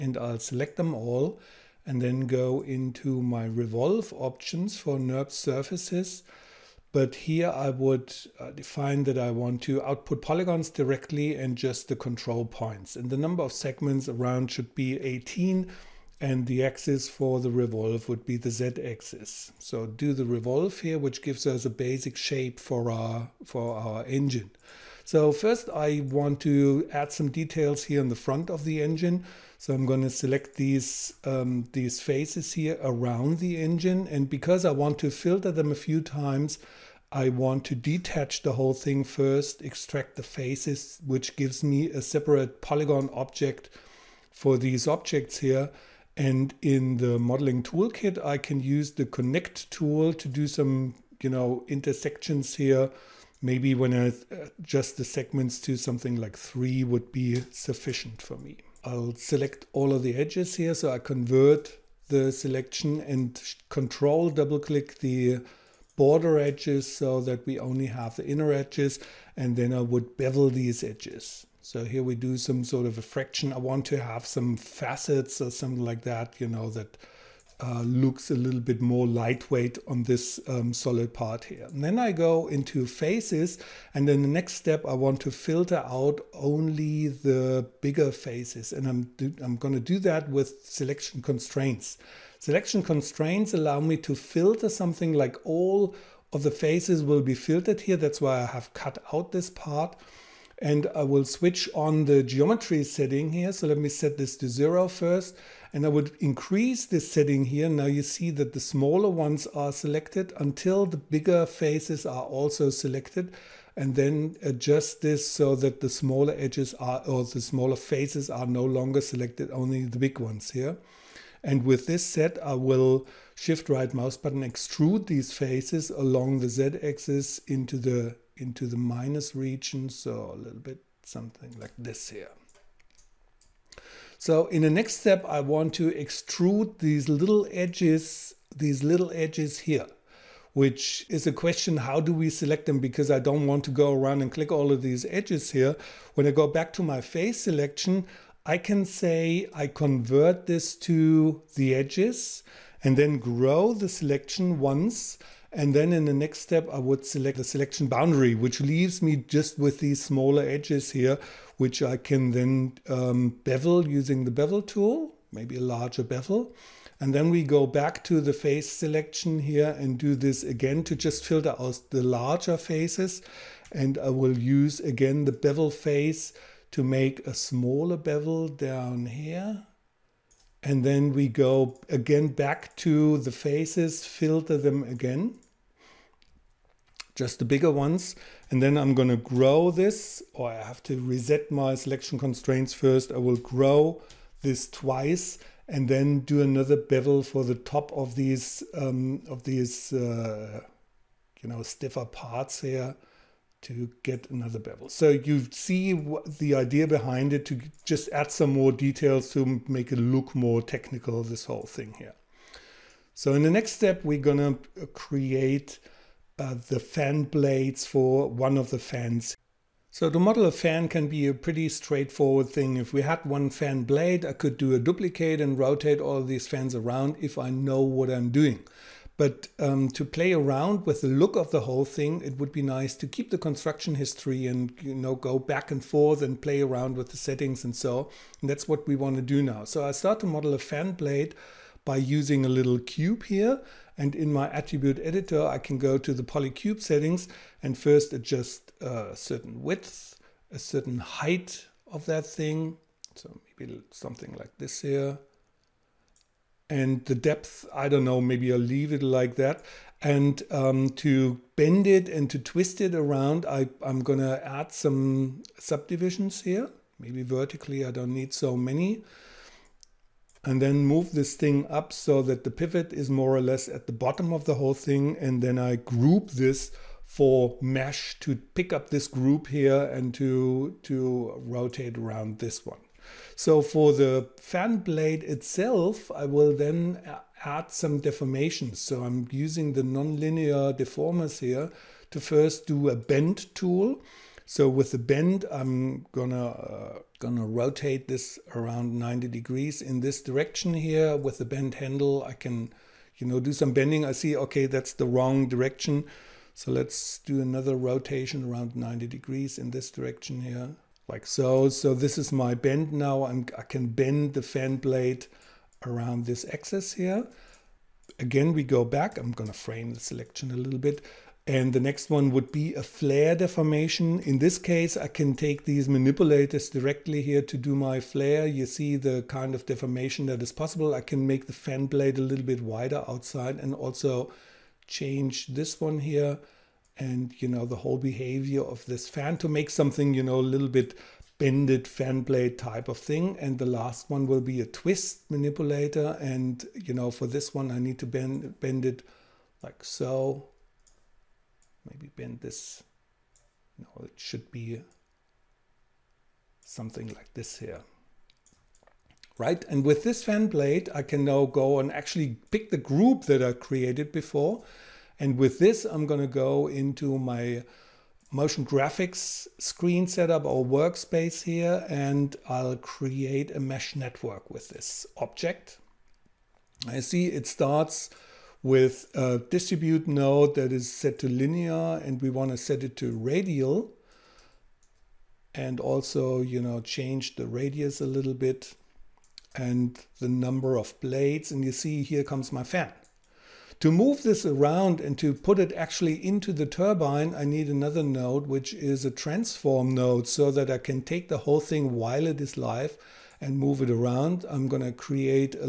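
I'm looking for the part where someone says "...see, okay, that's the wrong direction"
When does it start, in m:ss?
5:04.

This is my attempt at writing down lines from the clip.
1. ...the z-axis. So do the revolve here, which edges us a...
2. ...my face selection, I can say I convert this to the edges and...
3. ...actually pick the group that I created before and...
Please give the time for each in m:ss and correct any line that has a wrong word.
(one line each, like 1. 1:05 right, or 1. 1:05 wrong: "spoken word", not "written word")
1. 0:18 wrong: "gives", not "edges"
2. 2:26 right
3. 6:01 right.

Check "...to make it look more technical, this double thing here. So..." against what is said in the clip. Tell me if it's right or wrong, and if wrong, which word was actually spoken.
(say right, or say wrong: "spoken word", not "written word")
wrong: "whole", not "double".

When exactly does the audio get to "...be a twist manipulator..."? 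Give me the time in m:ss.
5:44.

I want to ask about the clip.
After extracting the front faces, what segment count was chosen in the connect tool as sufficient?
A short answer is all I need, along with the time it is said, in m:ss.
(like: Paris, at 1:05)
three, at 0:56.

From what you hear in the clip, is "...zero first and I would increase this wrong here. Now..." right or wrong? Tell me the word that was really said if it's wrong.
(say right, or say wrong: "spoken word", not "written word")
wrong: "setting", not "wrong".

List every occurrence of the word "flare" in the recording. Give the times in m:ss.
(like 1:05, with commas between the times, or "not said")
5:22, 5:28.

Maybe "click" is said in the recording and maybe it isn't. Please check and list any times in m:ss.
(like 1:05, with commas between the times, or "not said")
1:04, 2:24.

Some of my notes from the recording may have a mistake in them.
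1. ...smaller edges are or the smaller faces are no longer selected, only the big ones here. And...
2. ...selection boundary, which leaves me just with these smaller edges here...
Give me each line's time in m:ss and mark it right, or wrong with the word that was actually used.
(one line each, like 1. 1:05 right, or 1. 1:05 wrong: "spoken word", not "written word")
1. 1:55 right
2. 2:37 right.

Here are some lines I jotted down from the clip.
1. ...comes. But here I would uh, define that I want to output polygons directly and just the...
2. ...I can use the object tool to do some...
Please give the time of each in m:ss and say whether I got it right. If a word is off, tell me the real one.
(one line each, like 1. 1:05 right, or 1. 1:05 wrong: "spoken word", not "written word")
1. 0:05 wrong: "surfaces", not "comes"
2. 0:48 wrong: "connect", not "object".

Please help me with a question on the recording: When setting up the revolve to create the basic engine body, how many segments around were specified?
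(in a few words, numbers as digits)
18.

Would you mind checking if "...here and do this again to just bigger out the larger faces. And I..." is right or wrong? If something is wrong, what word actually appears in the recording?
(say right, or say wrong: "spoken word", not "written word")
wrong: "filter", not "bigger".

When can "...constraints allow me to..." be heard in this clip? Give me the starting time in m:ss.
1:32.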